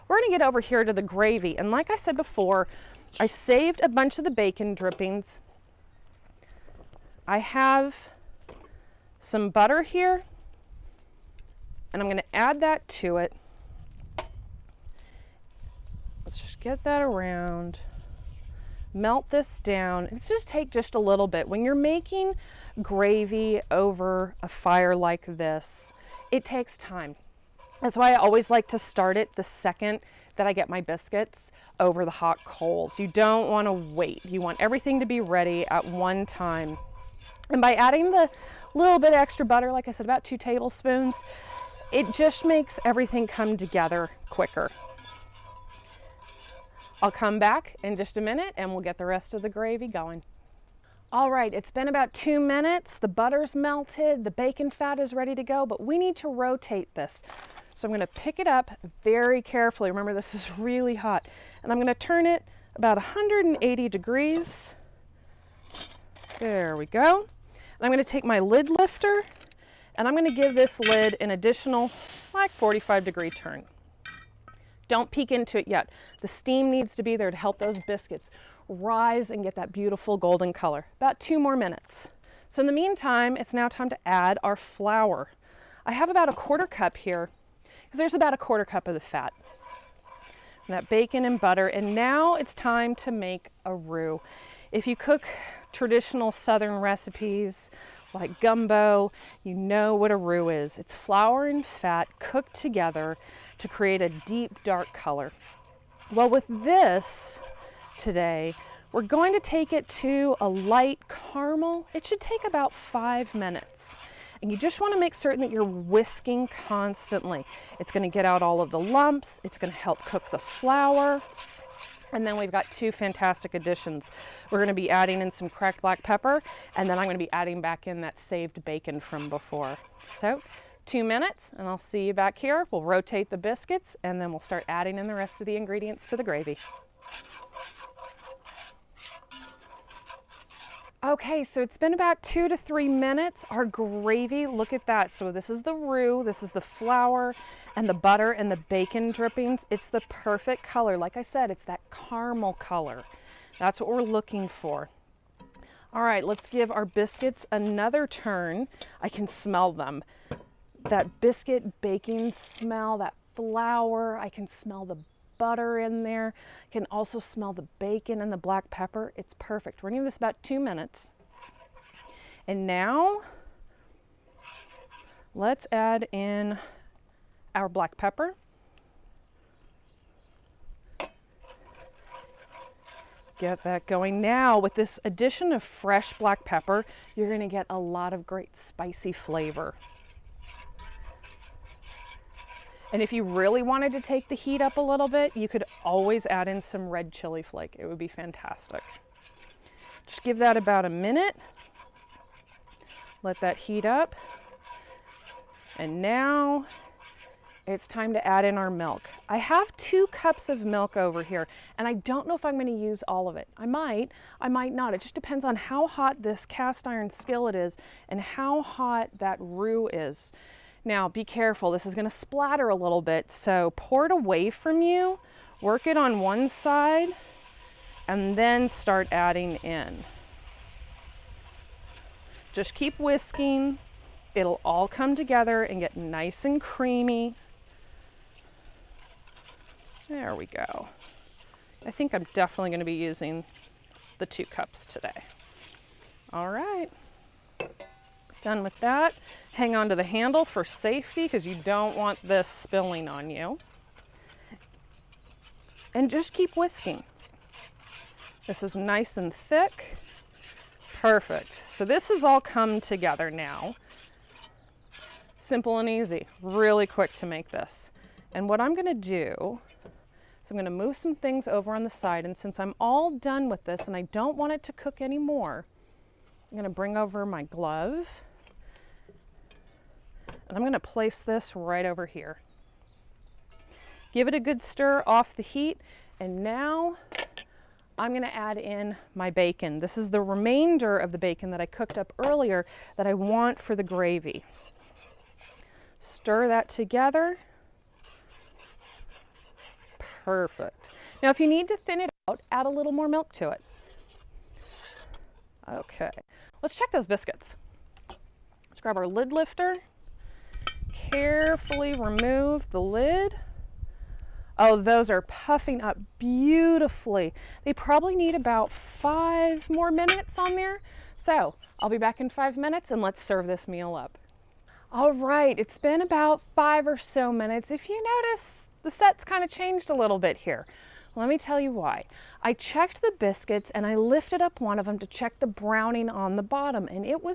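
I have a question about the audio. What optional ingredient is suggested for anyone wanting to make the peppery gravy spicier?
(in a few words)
red chili flake.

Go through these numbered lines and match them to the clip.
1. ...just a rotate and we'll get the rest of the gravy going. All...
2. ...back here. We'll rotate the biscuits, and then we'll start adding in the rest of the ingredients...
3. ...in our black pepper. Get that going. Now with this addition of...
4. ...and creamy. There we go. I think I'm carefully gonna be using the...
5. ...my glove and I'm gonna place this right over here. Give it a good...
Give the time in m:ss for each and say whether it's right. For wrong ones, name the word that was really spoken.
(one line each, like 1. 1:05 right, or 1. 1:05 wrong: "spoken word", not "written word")
1. 0:47 wrong: "minute", not "rotate"
2. 2:12 right
3. 2:56 right
4. 3:56 wrong: "definitely", not "carefully"
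5. 4:37 right.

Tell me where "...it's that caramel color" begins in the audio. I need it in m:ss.
2:31.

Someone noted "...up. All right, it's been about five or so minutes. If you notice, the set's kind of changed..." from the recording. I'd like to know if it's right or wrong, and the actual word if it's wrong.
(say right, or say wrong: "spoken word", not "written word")
right.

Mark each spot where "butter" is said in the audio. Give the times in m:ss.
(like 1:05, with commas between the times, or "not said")
0:09, 0:39, 0:53, 1:31, 2:27, 2:45.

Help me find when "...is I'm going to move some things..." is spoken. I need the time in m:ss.
4:30.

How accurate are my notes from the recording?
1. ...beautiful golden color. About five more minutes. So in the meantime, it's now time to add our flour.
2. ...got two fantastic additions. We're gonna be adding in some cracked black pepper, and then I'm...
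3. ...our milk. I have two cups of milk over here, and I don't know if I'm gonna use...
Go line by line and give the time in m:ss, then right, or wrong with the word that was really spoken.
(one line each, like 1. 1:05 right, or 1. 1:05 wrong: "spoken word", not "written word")
1. 1:19 wrong: "two", not "five"
2. 2:02 right
3. 3:28 right.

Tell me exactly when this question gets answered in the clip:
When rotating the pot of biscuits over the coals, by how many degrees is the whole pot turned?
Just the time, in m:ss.
1:02.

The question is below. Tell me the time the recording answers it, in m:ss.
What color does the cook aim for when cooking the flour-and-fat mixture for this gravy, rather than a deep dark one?
1:50.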